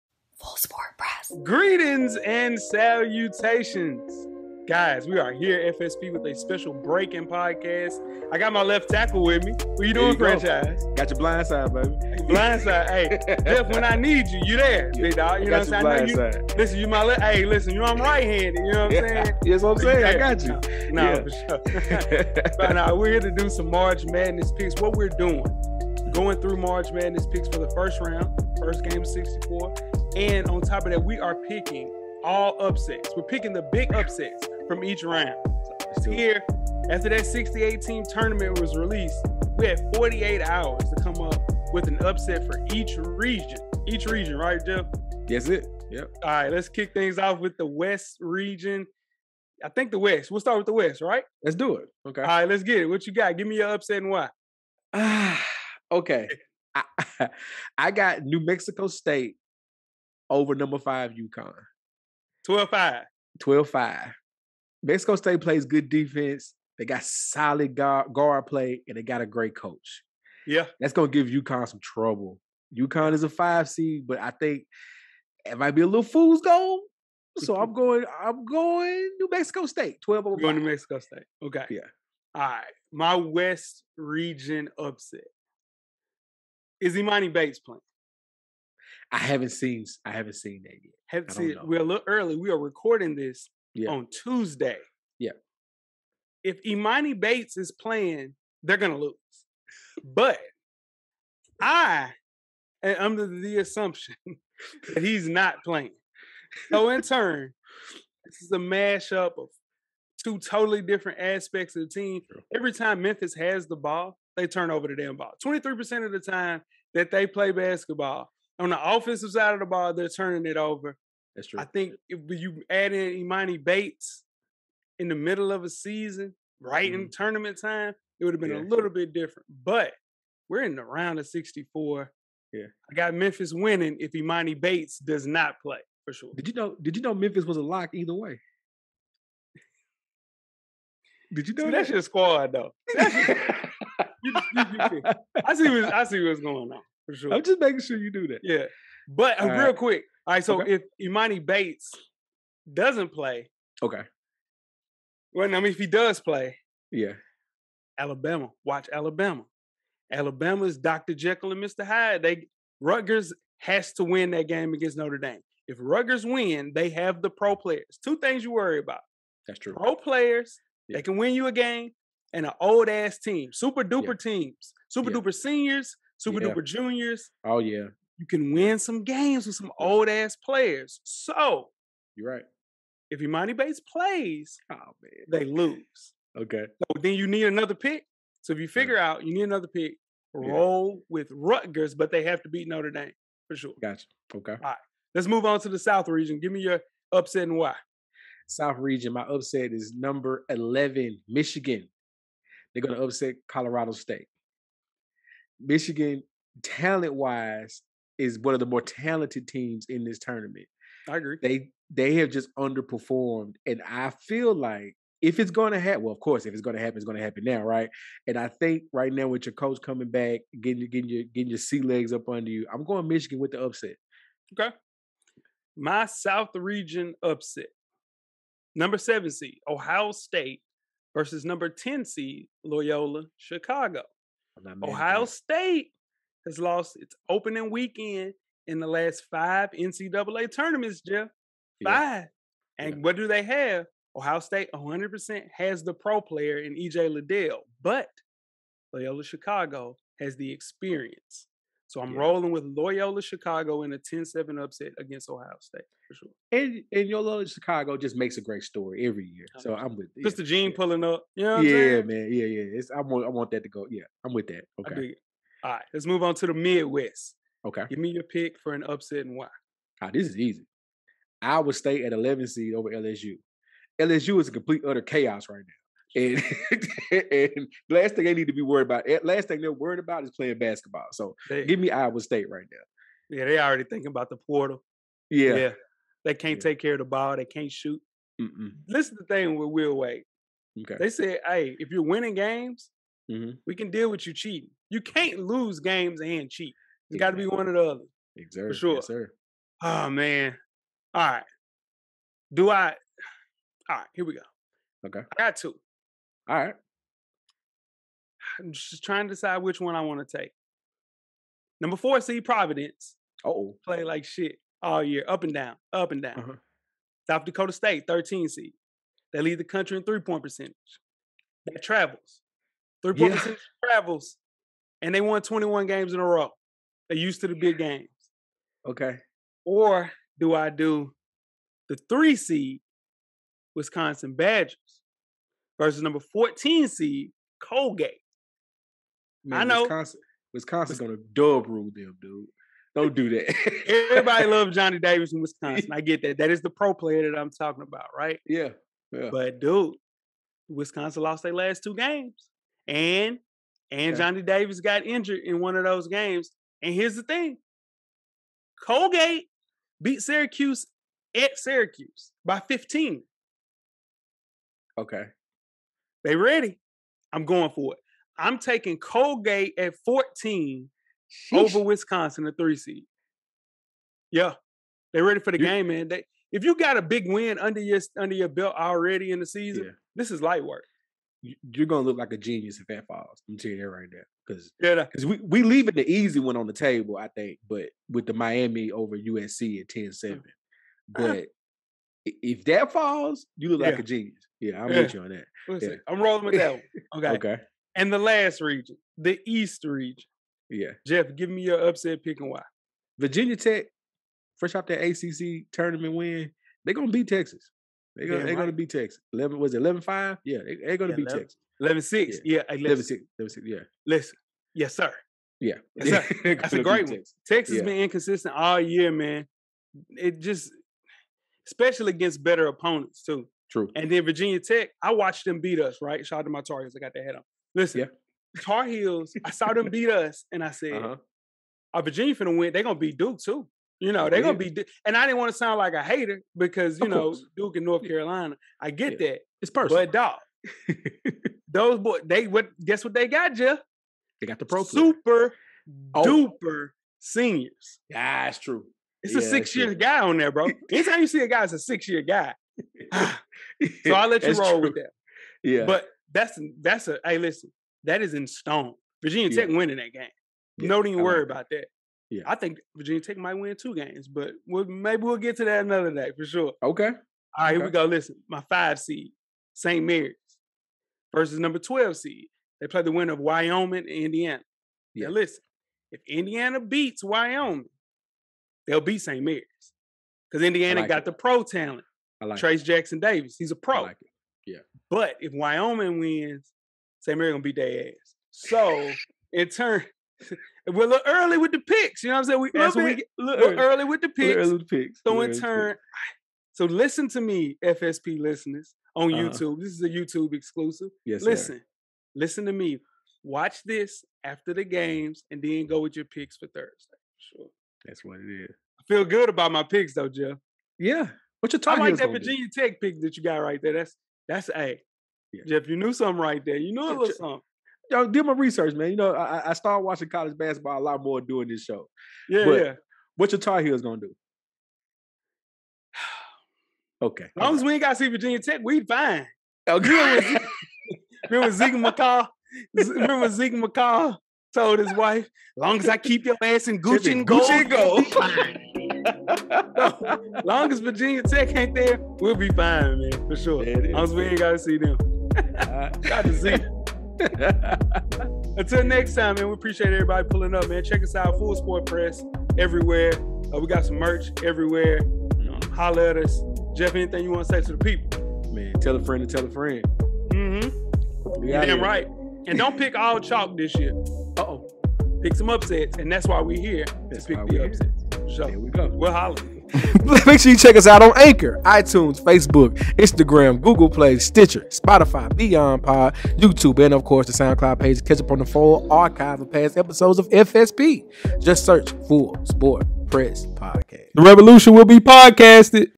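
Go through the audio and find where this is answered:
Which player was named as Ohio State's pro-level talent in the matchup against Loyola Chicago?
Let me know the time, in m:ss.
4:06.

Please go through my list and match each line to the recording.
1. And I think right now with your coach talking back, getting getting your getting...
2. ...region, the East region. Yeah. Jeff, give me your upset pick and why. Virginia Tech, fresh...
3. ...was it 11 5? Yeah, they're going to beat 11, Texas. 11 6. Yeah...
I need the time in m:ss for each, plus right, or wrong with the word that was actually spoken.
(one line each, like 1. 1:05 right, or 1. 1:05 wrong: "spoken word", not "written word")
1. 3:38 wrong: "coming", not "talking"
2. 6:38 right
3. 6:49 right.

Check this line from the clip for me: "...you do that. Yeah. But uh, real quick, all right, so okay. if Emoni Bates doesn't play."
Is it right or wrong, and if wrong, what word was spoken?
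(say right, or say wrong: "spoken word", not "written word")
right.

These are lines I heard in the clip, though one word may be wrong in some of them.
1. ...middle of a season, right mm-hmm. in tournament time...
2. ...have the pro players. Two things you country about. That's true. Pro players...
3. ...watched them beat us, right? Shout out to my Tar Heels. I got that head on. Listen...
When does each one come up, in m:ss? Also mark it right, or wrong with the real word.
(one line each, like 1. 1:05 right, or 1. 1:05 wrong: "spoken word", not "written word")
1. 2:05 right
2. 2:46 wrong: "worry", not "country"
3. 7:05 right.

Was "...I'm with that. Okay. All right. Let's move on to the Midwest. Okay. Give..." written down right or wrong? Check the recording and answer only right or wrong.
right.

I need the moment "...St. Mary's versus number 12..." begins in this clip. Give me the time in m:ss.
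7:49.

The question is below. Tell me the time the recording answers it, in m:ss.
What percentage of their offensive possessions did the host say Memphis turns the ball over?
1:55.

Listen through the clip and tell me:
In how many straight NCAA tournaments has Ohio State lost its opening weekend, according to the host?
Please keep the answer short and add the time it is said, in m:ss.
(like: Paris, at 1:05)
5, at 3:58.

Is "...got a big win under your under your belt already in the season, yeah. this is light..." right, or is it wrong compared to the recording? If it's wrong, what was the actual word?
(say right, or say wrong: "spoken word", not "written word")
right.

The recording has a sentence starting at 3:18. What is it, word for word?
South region, my upset is number 11, Michigan.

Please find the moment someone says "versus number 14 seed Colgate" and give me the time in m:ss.
5:35.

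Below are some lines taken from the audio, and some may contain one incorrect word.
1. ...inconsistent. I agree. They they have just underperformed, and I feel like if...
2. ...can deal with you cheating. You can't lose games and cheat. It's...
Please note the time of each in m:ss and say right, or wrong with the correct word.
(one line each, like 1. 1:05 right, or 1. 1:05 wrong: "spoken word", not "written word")
1. 3:30 wrong: "tournament", not "inconsistent"
2. 4:53 right.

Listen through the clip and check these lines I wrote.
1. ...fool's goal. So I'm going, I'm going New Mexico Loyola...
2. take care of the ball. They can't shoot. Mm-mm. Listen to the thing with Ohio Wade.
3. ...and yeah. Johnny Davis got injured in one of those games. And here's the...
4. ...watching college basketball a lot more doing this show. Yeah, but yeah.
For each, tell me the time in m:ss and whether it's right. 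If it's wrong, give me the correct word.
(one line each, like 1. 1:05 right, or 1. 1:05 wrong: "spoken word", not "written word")
1. 1:16 wrong: "State", not "Loyola"
2. 4:46 wrong: "Will", not "Ohio"
3. 5:53 right
4. 8:40 right.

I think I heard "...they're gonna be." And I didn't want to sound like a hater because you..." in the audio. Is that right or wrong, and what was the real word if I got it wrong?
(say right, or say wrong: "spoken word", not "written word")
right.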